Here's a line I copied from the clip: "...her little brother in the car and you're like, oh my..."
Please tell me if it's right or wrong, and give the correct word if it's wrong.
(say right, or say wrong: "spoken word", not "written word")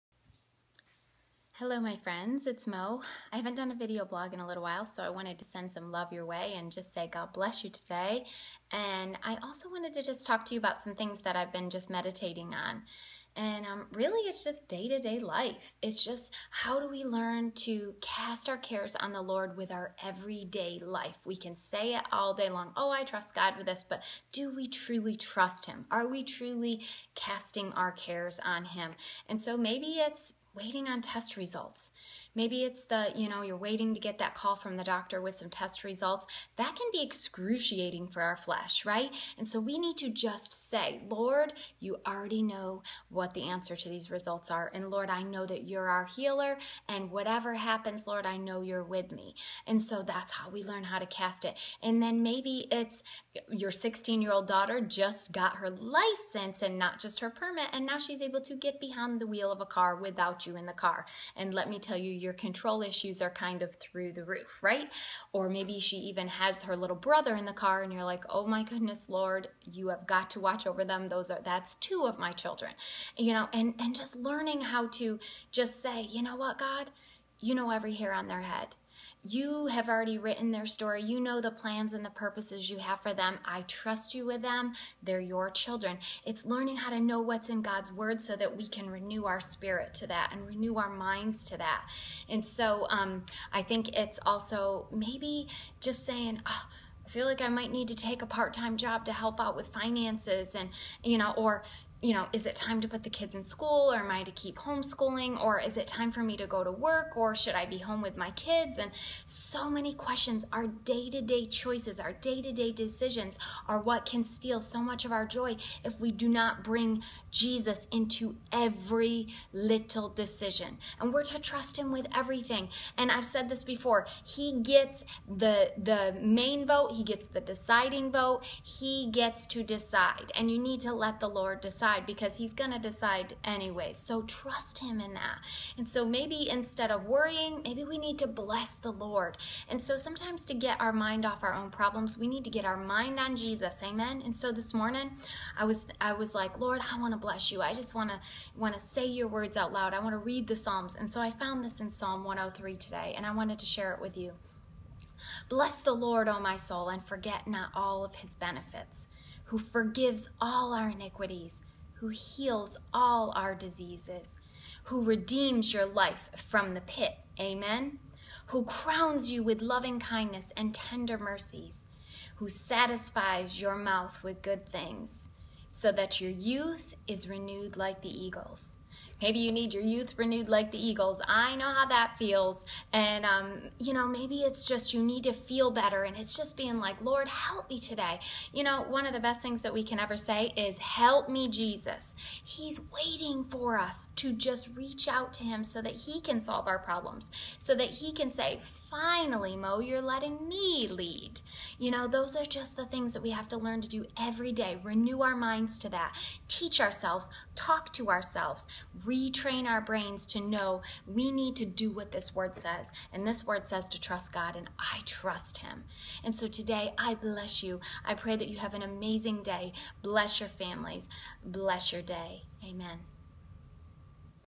right.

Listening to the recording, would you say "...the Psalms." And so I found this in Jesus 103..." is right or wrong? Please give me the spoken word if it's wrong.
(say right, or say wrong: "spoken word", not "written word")
wrong: "Psalm", not "Jesus".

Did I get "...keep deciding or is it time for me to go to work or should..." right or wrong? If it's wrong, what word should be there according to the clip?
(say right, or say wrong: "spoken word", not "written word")
wrong: "homeschooling", not "deciding".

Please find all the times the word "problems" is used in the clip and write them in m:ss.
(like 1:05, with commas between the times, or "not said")
2:21, 3:16.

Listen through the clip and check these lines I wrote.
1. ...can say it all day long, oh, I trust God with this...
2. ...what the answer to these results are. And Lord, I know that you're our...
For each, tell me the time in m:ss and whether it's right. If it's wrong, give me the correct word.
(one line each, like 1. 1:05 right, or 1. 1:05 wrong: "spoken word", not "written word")
1. 0:21 right
2. 0:43 right.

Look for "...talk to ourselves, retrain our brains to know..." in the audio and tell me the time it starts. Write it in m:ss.
3:27.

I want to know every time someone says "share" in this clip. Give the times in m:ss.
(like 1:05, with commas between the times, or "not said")
2:33.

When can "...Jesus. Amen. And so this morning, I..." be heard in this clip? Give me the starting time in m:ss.
2:23.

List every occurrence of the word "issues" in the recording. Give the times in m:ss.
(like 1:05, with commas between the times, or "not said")
1:02.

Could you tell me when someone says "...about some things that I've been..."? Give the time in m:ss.
0:10.